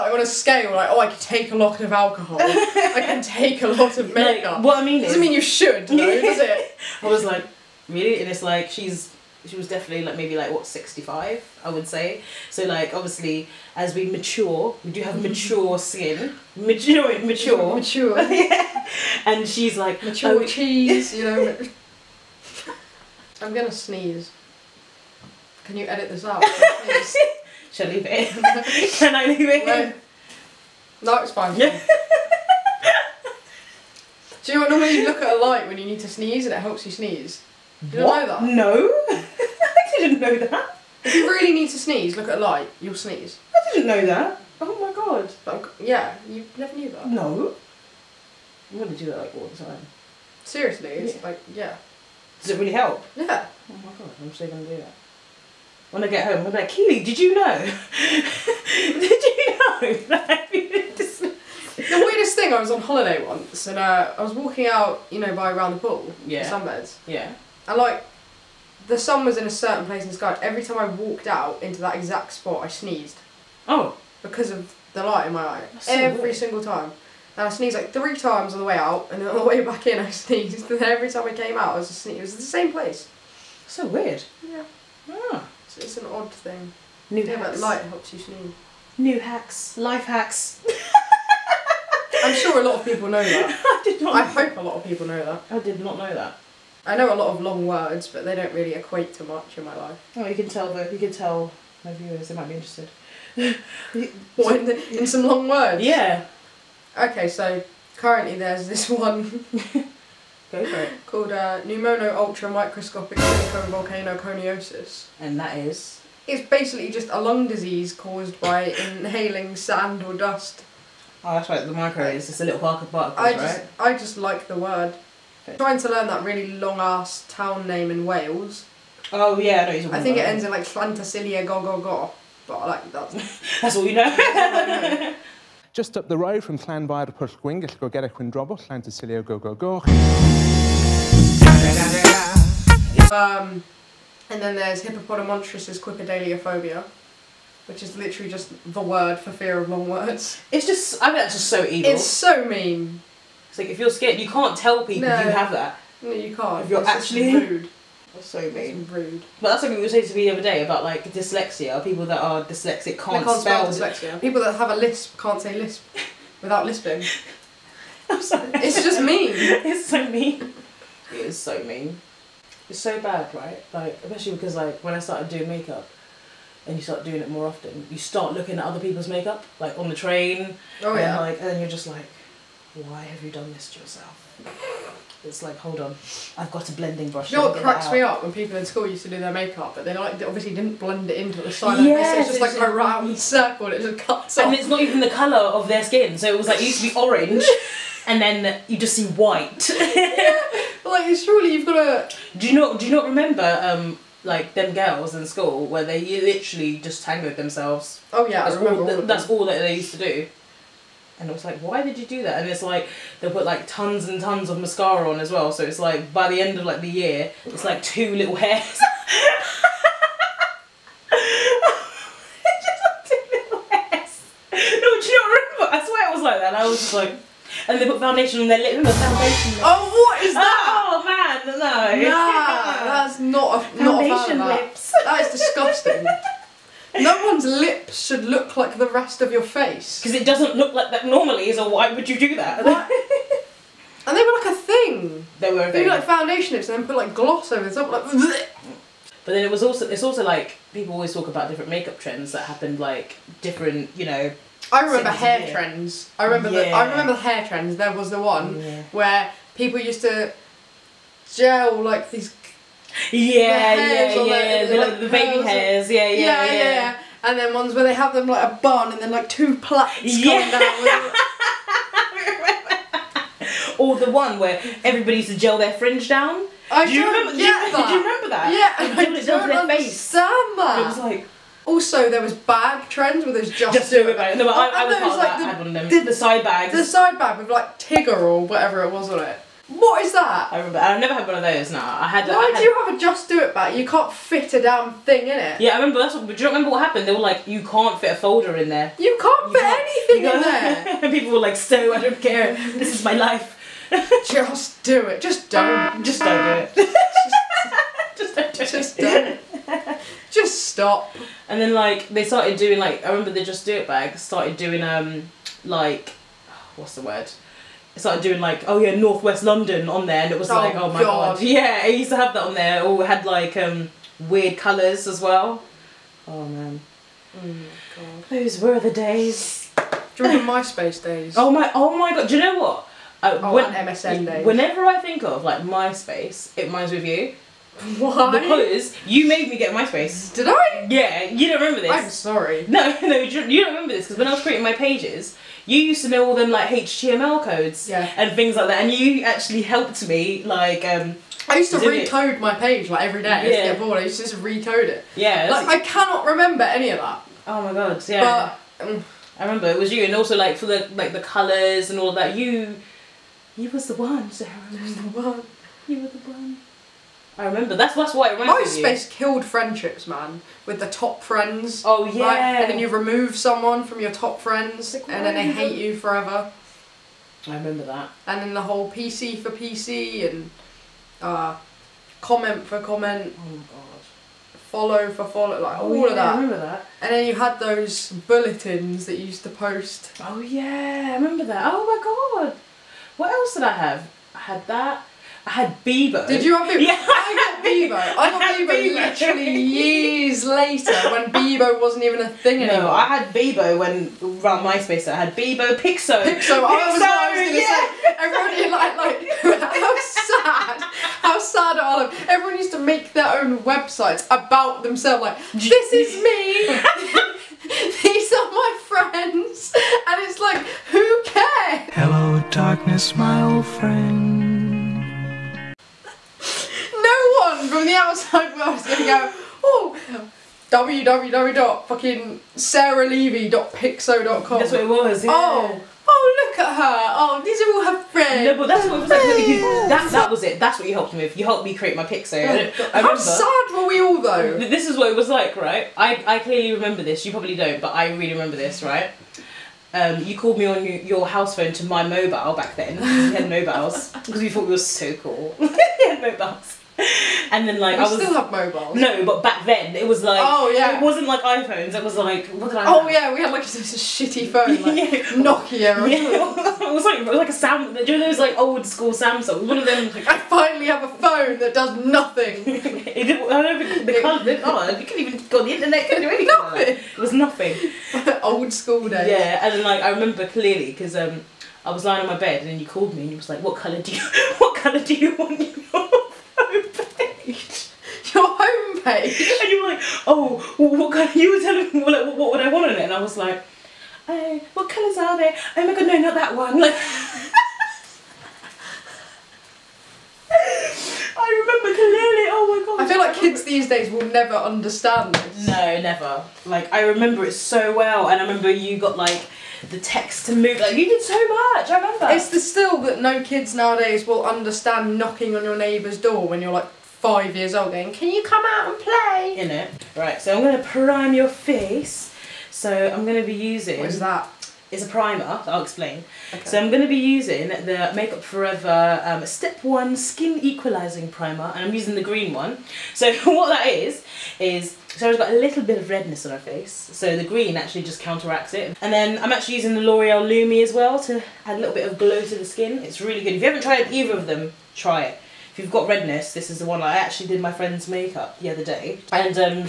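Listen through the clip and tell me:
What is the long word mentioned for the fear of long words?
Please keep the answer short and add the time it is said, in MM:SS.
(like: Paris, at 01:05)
Hippopotamontrus's Quipidaliophobia, at 02:24.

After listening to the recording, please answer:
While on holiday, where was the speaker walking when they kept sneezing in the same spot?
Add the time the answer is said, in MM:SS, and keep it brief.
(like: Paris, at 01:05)
Around the pool, at 01:05.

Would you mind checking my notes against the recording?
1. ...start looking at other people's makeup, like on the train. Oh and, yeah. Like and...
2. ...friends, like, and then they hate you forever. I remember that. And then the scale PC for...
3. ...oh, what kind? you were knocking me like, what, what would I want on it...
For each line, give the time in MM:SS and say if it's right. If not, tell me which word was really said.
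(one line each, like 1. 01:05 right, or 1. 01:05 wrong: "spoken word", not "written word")
1. 02:57 right
2. 06:14 wrong: "whole", not "scale"
3. 08:10 wrong: "telling", not "knocking".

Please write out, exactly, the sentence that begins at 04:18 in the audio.
where people used to gel like these yeah, yeah, yeah.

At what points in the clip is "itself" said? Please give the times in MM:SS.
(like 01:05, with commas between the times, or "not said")
not said.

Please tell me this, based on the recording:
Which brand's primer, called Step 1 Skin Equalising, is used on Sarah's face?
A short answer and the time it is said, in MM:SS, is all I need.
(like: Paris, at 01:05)
Makeup Forever, at 08:48.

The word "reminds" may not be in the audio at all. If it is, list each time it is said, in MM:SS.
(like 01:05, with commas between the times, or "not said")
05:36, 06:08.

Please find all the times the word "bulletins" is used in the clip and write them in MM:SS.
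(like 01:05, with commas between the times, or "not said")
06:28.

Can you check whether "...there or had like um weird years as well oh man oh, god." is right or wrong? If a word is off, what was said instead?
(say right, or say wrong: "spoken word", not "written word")
wrong: "colors", not "years".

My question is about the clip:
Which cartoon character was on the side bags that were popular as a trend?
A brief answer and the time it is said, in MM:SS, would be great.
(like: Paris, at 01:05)
Tigger, at 04:47.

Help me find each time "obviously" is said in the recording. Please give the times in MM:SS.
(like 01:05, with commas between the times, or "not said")
00:12, 03:10.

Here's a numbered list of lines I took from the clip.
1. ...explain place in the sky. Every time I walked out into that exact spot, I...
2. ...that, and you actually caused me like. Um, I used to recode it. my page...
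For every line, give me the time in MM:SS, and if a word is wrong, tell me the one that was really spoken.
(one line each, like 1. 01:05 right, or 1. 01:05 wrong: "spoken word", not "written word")
1. 01:09 wrong: "certain", not "explain"
2. 05:48 wrong: "helped", not "caused".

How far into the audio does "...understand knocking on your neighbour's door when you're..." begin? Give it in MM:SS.
08:34.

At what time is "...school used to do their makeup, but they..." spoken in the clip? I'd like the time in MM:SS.
03:08.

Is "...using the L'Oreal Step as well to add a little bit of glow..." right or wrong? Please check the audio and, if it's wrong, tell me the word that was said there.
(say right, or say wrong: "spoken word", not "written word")
wrong: "Lumi", not "Step".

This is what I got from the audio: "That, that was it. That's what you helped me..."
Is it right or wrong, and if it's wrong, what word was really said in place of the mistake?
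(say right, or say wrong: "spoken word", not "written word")
right.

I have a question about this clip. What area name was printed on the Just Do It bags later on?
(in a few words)
Northwest London.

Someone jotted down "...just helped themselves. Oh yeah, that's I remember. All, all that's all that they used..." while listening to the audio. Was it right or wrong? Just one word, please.
wrong.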